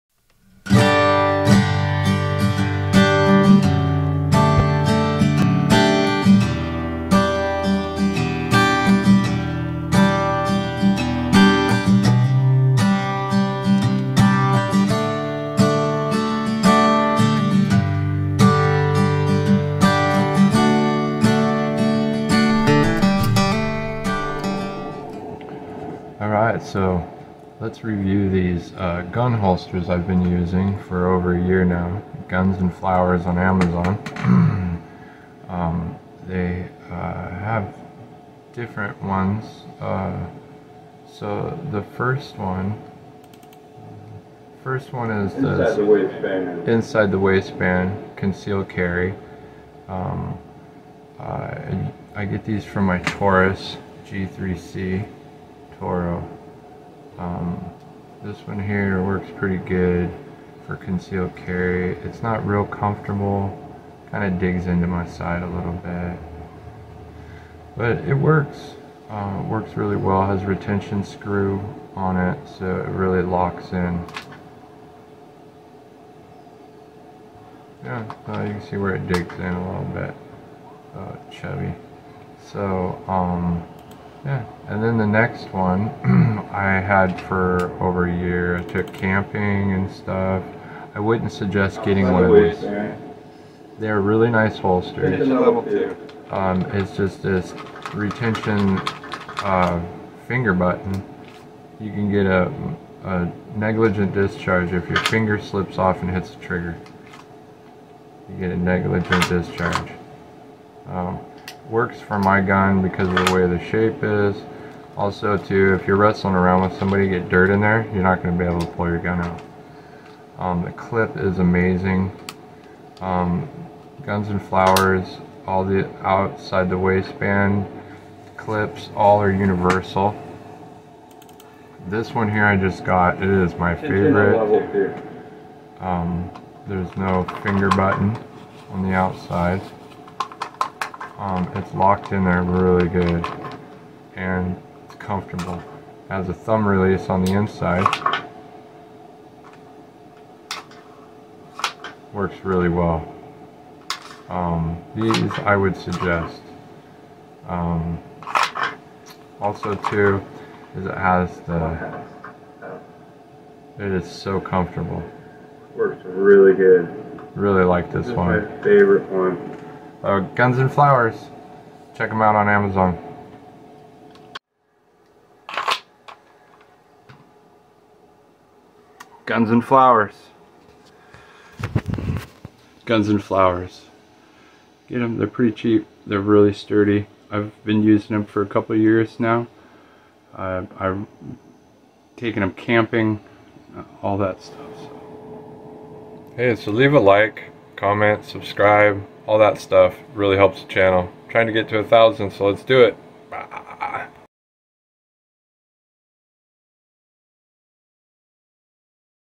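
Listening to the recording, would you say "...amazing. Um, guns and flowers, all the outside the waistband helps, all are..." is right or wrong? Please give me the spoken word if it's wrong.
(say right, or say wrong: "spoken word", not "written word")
wrong: "clips", not "helps".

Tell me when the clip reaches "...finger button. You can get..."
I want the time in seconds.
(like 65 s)
100 s.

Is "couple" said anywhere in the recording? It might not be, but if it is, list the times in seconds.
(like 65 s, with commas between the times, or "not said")
188 s.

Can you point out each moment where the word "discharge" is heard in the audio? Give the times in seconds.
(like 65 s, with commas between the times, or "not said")
104 s, 109 s.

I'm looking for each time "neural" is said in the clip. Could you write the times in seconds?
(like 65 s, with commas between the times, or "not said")
not said.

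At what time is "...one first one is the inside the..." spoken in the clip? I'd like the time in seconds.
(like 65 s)
42 s.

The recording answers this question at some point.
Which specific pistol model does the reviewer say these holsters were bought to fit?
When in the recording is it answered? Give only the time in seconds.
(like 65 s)
52 s.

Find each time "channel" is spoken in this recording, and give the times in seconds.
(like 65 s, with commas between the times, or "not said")
200 s.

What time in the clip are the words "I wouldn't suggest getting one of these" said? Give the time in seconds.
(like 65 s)
90 s.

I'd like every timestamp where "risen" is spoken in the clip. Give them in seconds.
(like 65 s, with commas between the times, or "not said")
not said.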